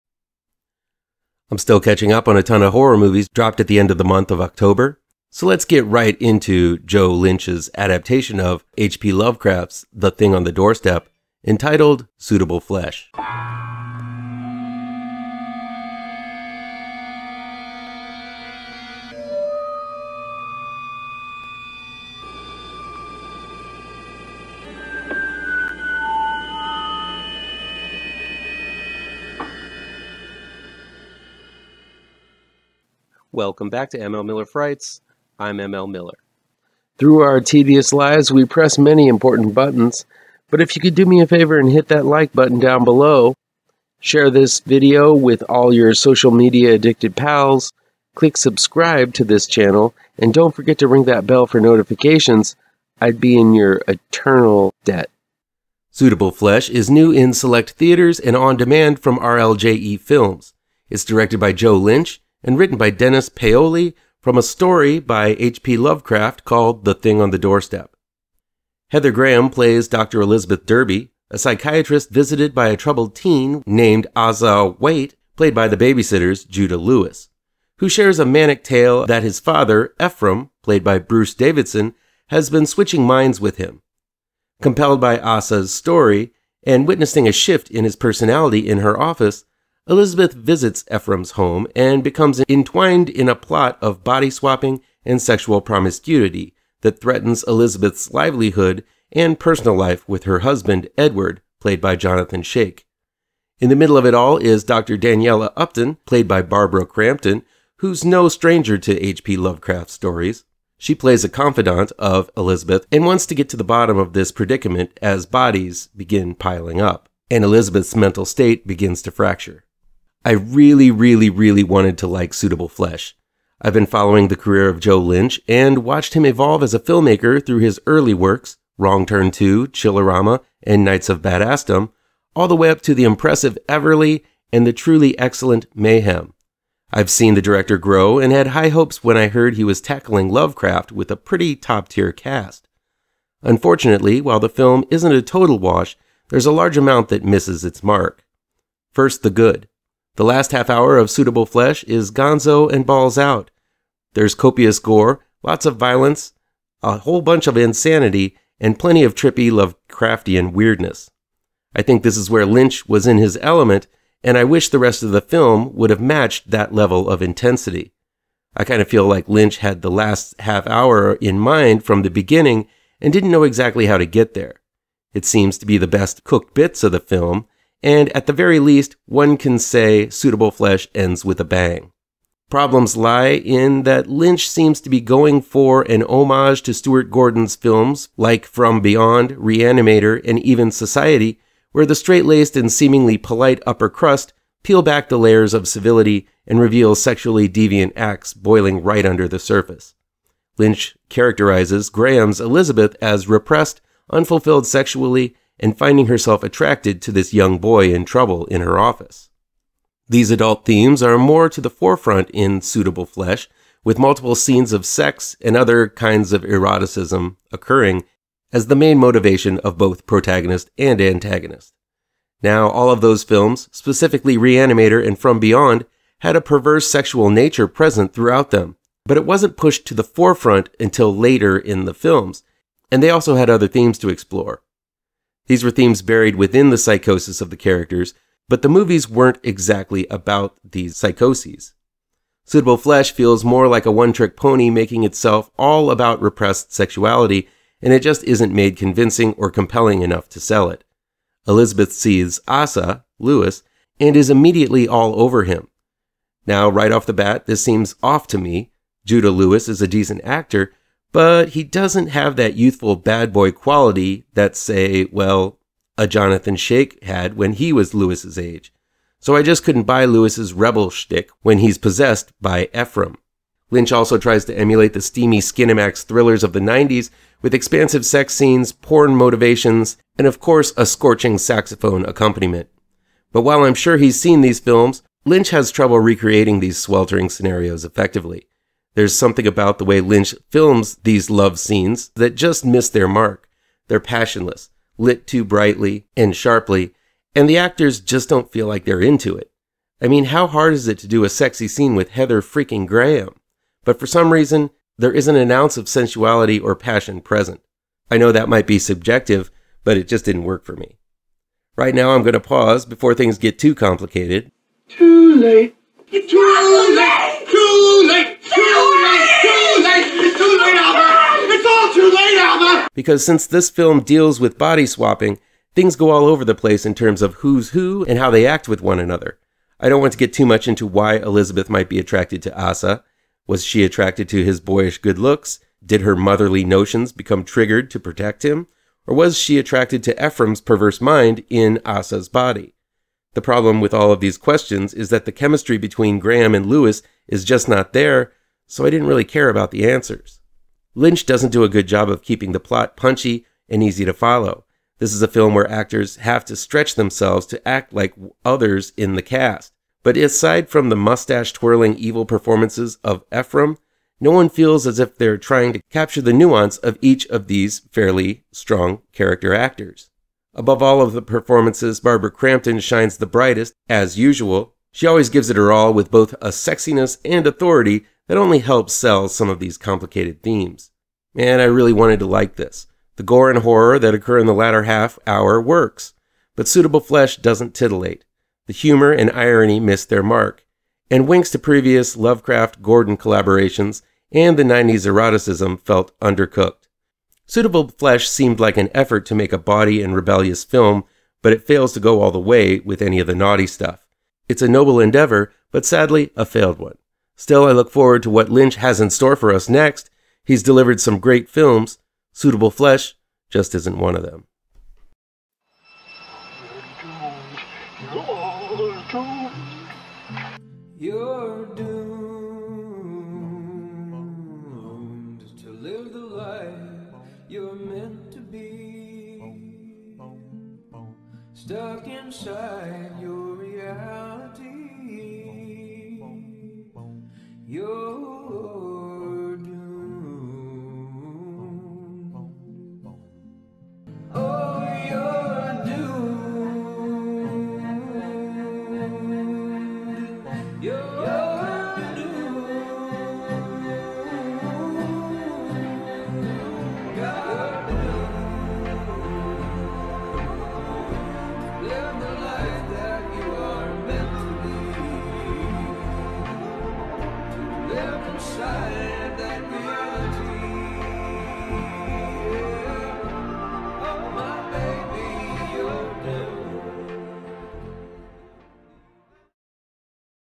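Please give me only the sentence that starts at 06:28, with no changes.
The humor and irony miss their mark, and winks to previous Lovecraft Gordon collaborations and the 90s eroticism felt undercooked.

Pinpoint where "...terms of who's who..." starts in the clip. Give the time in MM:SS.
05:26.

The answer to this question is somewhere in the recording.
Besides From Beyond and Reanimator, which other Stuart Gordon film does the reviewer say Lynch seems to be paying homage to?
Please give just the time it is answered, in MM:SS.
03:10.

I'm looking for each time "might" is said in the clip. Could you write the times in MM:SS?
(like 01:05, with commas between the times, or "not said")
05:08, 05:31.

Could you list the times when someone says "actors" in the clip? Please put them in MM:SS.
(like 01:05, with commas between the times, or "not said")
04:20, 04:57, 05:55, 06:09.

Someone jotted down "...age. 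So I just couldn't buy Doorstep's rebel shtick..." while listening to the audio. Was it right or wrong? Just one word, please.
wrong.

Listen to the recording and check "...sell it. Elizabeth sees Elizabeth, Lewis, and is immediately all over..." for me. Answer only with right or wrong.
wrong.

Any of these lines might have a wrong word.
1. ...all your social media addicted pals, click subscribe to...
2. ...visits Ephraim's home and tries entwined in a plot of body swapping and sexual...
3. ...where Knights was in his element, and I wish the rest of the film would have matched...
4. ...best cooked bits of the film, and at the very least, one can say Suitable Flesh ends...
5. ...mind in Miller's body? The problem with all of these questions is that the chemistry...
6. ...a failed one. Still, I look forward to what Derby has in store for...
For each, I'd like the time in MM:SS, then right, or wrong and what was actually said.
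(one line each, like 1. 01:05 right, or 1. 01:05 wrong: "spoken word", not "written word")
1. 00:45 right
2. 01:30 wrong: "becomes", not "tries"
3. 02:42 wrong: "Lynch", not "Knights"
4. 02:55 right
5. 05:41 wrong: "Asa", not "Miller"
6. 06:46 wrong: "Lynch", not "Derby".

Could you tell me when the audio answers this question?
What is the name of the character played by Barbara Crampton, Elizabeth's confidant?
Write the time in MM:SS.
01:44.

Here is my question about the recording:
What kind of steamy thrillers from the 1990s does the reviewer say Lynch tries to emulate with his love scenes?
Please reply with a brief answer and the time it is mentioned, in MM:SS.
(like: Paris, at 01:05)
Skinemax thrillers, at 04:35.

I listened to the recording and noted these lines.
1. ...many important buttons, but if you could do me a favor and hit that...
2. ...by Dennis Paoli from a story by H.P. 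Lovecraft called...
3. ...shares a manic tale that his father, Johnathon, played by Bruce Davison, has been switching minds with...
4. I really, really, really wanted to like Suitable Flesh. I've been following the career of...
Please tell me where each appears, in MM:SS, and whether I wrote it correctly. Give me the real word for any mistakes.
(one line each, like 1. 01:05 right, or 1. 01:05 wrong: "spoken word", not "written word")
1. 00:38 right
2. 01:02 right
3. 01:17 wrong: "Ephraim", not "Johnathon"
4. 02:00 right.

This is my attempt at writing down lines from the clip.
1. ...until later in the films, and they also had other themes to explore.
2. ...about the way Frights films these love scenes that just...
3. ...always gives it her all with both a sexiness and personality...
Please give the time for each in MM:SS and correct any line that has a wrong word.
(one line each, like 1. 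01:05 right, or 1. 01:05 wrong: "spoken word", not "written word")
1. 03:50 right
2. 04:49 wrong: "Lynch", not "Frights"
3. 06:15 wrong: "authority", not "personality".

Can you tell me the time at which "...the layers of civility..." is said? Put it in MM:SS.
03:15.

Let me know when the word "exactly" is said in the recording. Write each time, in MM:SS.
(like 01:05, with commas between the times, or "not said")
02:53, 03:59.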